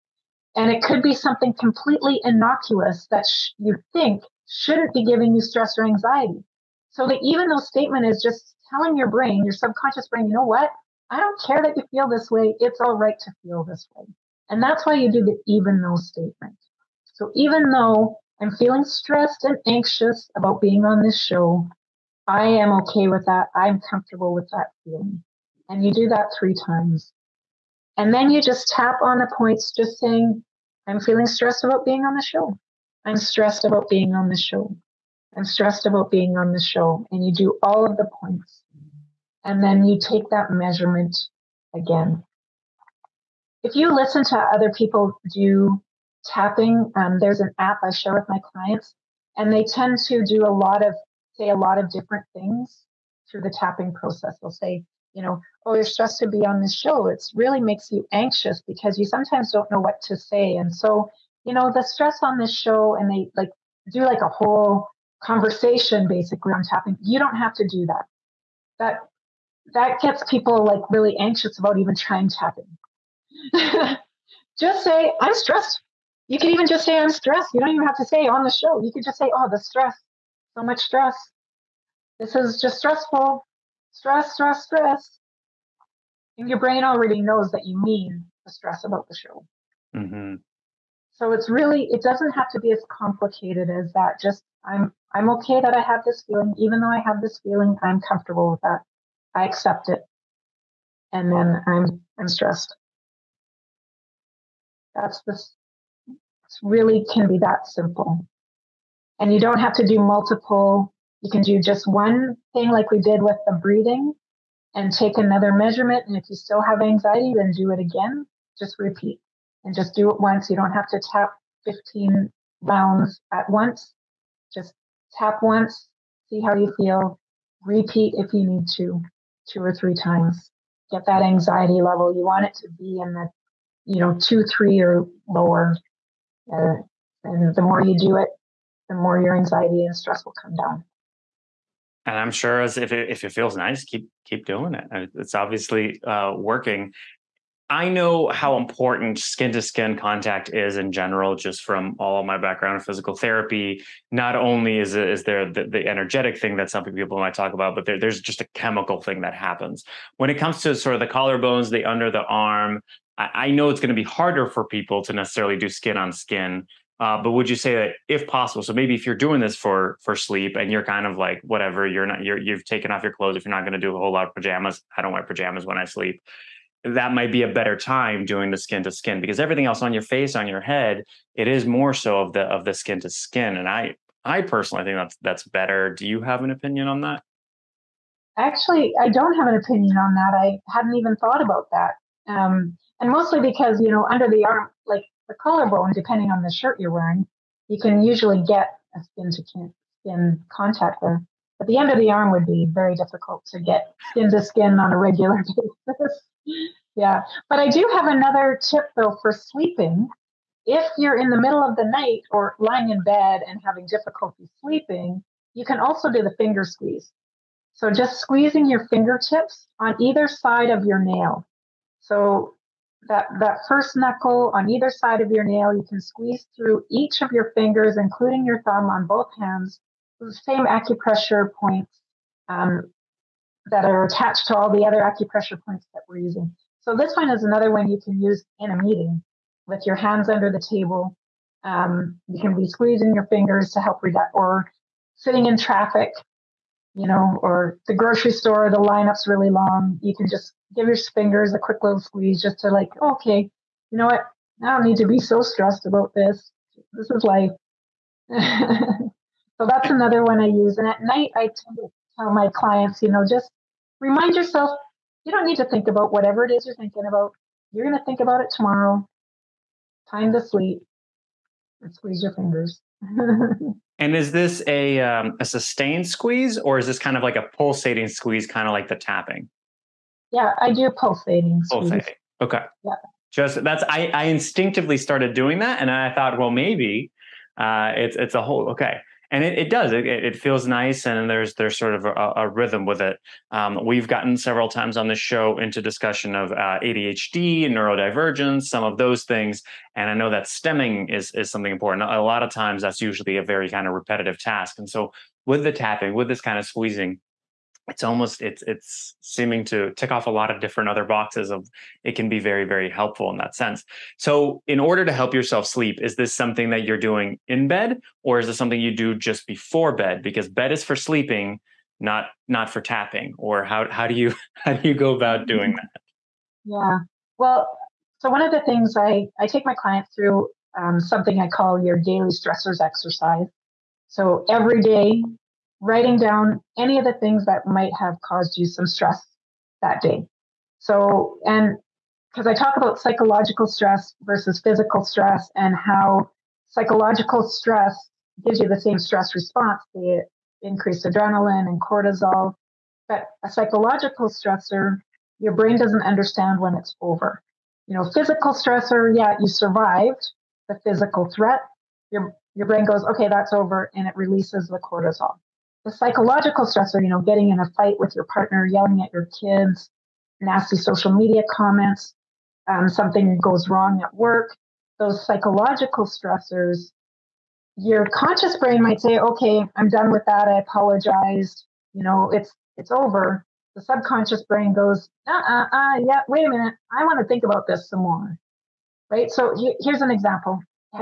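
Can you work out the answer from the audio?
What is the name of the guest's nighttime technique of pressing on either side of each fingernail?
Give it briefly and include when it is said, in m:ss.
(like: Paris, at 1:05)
finger squeeze, at 3:36.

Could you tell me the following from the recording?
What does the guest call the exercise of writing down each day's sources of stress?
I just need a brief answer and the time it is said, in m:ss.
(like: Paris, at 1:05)
daily stressors exercise, at 5:31.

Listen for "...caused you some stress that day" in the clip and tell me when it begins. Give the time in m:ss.
5:38.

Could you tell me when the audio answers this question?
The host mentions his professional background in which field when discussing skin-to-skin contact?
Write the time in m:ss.
2:32.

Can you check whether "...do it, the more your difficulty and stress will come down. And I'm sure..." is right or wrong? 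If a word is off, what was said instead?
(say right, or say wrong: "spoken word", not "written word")
wrong: "anxiety", not "difficulty".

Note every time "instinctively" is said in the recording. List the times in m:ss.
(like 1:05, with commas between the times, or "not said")
4:44.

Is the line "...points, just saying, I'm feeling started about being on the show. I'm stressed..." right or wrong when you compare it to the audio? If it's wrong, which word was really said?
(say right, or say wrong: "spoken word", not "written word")
wrong: "stressed", not "started".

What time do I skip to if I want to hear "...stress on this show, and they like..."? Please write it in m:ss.
1:01.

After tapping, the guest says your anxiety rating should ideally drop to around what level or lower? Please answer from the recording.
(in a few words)
2 or 3.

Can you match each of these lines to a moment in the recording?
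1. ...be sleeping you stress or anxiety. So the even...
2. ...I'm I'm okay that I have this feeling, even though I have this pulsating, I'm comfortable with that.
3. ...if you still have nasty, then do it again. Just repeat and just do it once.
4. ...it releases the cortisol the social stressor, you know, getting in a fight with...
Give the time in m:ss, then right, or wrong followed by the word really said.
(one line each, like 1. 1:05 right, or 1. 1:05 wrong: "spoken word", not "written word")
1. 0:04 wrong: "giving", not "sleeping"
2. 1:34 wrong: "feeling", not "pulsating"
3. 1:56 wrong: "anxiety", not "nasty"
4. 6:04 wrong: "psychological", not "social".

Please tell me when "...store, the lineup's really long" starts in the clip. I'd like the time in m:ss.
4:08.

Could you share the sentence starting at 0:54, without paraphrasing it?
They'll say, you know, oh, you're stressed to be on this show.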